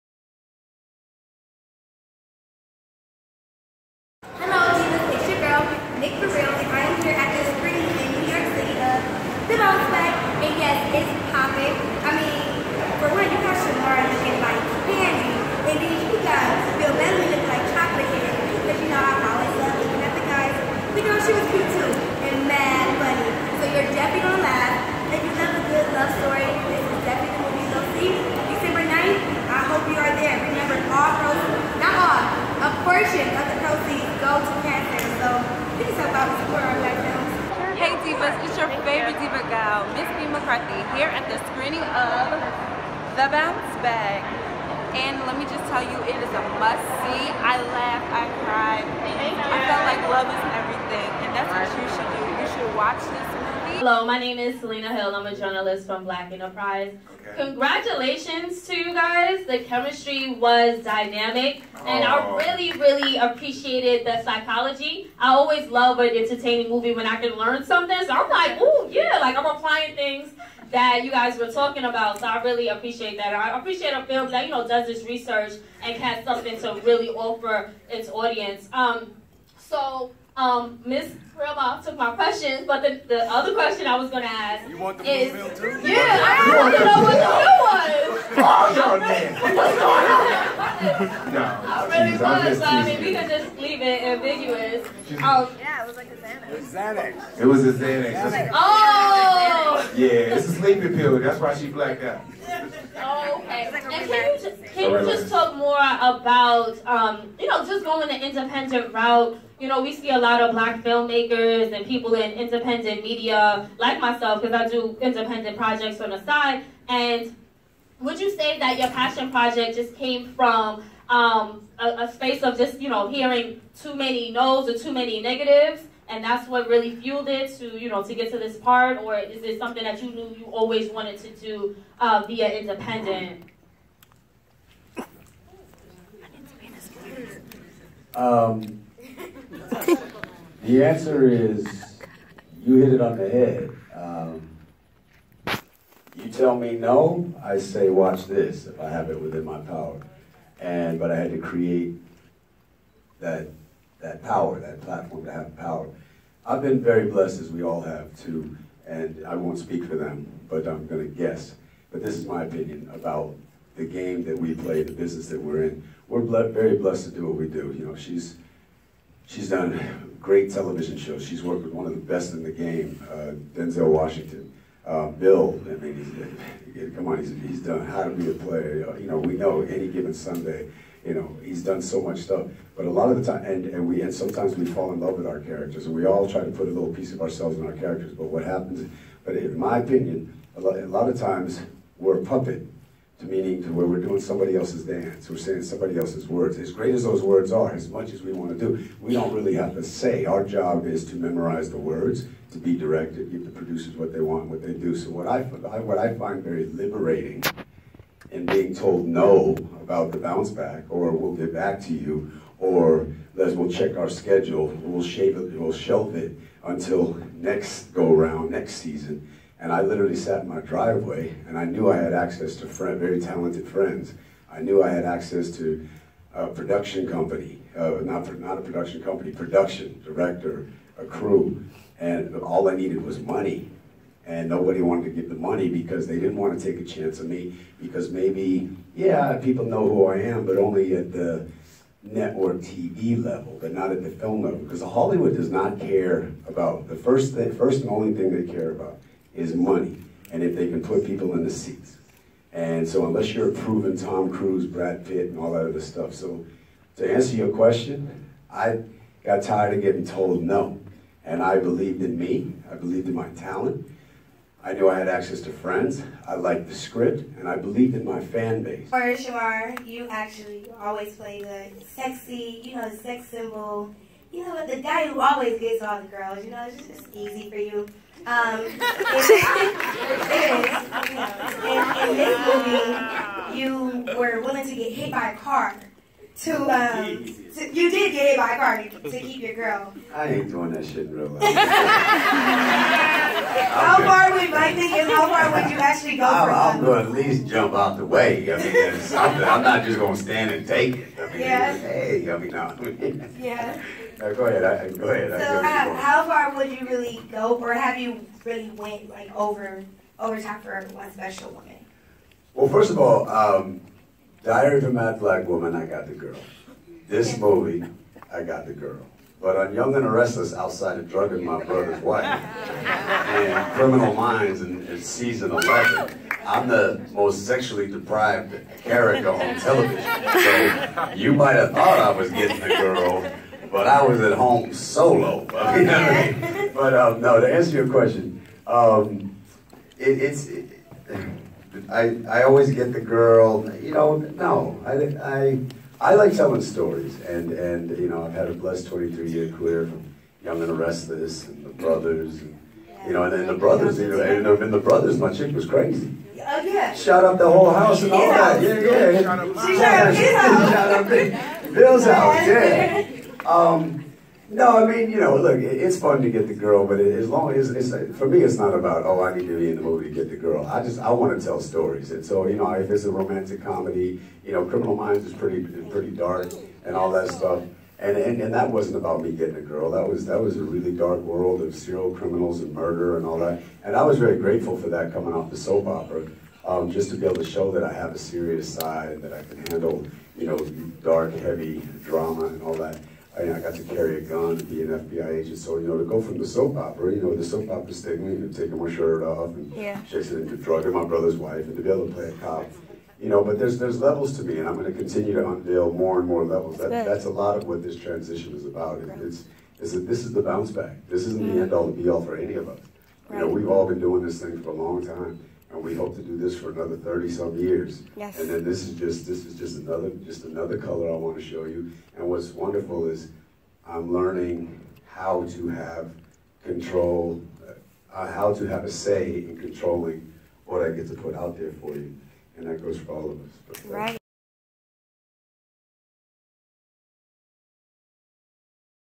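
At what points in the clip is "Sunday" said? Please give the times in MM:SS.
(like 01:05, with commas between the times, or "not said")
03:00.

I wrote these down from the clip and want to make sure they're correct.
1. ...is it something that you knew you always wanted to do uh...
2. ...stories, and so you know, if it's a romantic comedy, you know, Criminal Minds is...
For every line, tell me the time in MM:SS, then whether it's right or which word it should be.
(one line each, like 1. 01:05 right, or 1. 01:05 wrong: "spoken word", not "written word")
1. 02:09 right
2. 06:11 right.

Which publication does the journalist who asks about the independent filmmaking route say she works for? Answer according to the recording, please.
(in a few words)
Black Enterprise.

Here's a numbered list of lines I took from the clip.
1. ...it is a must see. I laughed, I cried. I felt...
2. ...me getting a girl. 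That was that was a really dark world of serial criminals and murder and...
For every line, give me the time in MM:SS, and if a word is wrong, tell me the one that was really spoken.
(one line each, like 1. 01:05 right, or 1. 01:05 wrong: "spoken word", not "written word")
1. 00:46 right
2. 06:19 right.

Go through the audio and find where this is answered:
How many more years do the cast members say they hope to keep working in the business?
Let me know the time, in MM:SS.
06:56.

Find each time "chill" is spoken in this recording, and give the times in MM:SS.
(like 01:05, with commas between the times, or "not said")
not said.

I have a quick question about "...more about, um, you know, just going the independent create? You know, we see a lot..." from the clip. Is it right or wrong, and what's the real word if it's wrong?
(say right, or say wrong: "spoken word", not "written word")
wrong: "route", not "create".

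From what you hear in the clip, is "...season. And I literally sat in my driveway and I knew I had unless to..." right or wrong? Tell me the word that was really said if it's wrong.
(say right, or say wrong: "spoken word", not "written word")
wrong: "access", not "unless".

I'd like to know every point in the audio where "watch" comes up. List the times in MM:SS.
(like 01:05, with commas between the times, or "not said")
00:52, 02:27.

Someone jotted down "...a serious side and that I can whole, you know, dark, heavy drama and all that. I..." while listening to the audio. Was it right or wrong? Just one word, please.
wrong.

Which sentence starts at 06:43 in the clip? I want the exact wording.
You know, but there's there's levels to me, and I'm going to continue to unveil more and more levels.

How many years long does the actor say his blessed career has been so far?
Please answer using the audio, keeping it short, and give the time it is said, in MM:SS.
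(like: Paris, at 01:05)
23, at 05:48.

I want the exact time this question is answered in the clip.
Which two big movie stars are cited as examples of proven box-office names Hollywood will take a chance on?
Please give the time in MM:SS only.
04:13.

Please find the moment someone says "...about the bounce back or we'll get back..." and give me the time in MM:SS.
03:29.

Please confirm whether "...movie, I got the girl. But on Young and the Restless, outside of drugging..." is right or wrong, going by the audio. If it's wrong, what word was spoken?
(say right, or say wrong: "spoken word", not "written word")
right.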